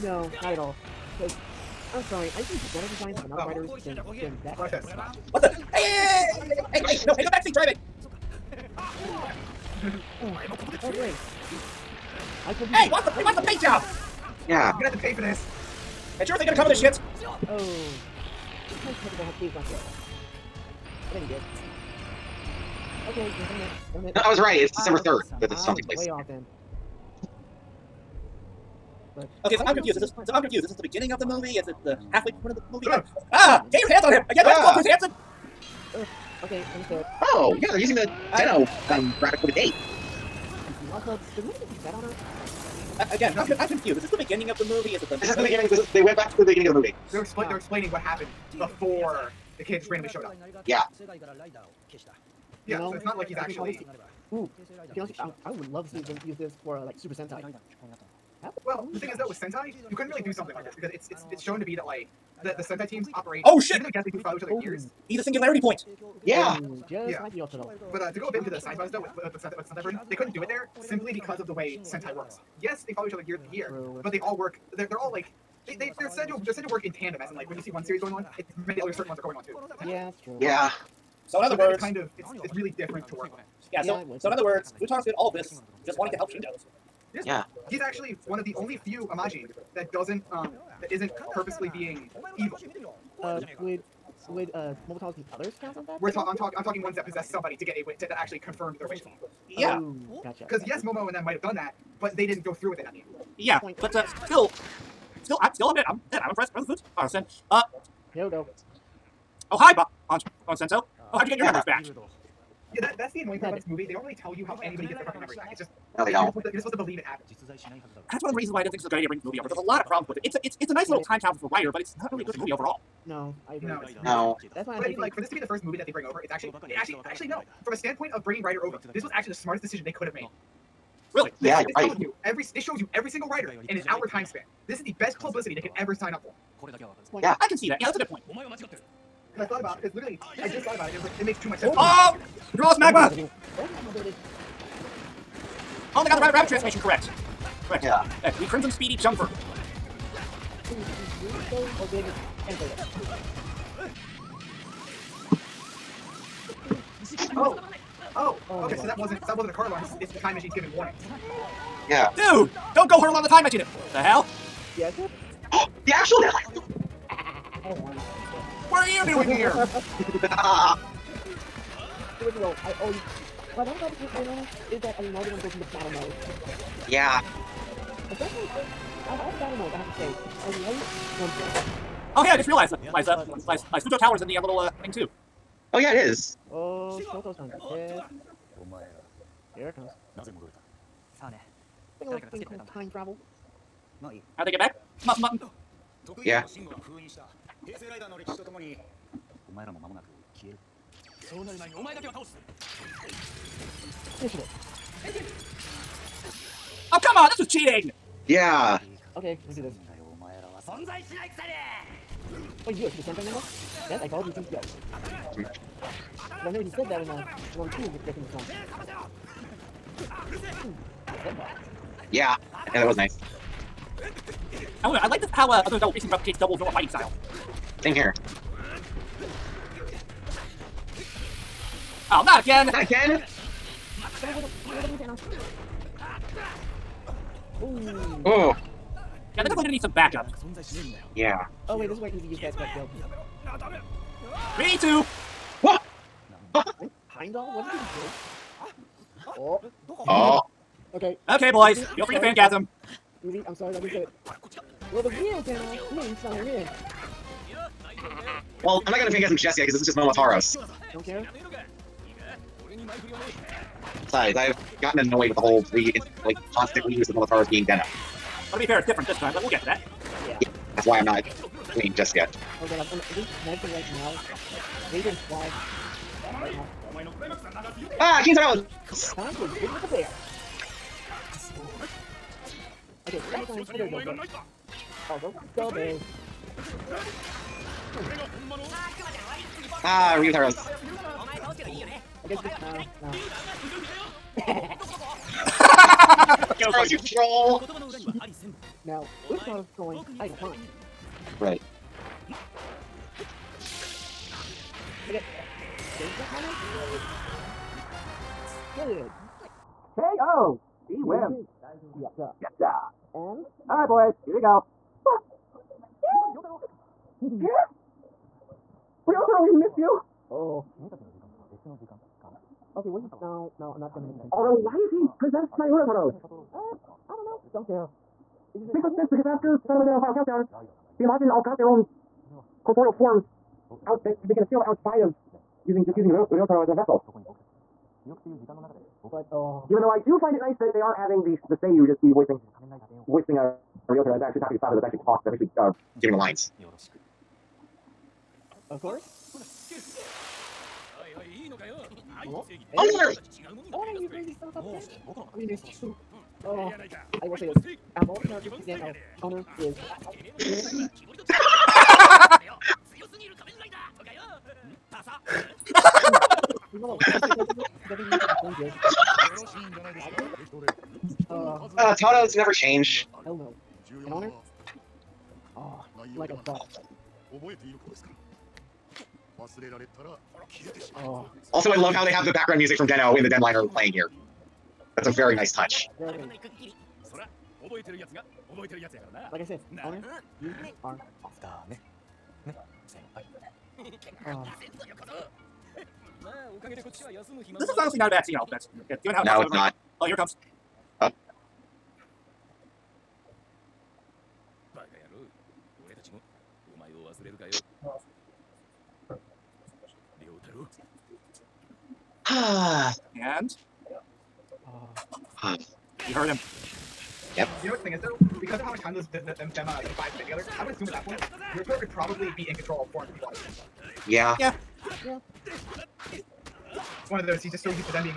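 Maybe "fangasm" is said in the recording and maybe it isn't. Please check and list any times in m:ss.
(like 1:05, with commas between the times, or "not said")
4:12, 4:19.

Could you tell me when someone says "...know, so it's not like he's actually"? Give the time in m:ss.
0:52.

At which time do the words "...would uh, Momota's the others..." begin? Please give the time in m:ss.
1:34.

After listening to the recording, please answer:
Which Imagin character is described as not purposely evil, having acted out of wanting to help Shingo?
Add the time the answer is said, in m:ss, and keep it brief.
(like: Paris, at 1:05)
Futaro, at 1:24.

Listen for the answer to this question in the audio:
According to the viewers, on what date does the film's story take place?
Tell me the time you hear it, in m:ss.
0:24.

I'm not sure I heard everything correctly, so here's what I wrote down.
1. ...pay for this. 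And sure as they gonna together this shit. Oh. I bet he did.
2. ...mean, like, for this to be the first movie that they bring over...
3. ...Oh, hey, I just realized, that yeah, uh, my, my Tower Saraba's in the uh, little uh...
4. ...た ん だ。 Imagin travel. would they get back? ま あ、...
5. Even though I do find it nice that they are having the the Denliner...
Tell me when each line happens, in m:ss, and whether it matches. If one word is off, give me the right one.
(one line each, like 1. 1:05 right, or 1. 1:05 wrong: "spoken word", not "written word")
1. 0:15 wrong: "cover", not "together"
2. 2:04 right
3. 3:02 wrong: "Tower", not "Saraba"
4. 3:12 wrong: "Time", not "Imagin"
5. 5:39 wrong: "Seiyu", not "Denliner".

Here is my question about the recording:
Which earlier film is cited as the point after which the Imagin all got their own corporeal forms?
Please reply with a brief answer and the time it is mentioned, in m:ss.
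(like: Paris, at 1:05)
Saraba Den-O Final Countdown, at 5:29.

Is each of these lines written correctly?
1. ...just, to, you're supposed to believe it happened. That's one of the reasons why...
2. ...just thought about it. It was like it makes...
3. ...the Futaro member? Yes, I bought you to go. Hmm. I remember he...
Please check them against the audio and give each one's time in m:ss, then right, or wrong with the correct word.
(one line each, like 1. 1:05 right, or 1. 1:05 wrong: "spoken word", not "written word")
1. 1:56 right
2. 2:20 right
3. 3:32 wrong: "Senpai", not "Futaro".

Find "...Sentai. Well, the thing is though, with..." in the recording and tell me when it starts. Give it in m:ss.
0:57.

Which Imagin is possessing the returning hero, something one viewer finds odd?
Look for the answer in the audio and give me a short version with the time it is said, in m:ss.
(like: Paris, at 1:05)
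Urataros, at 5:25.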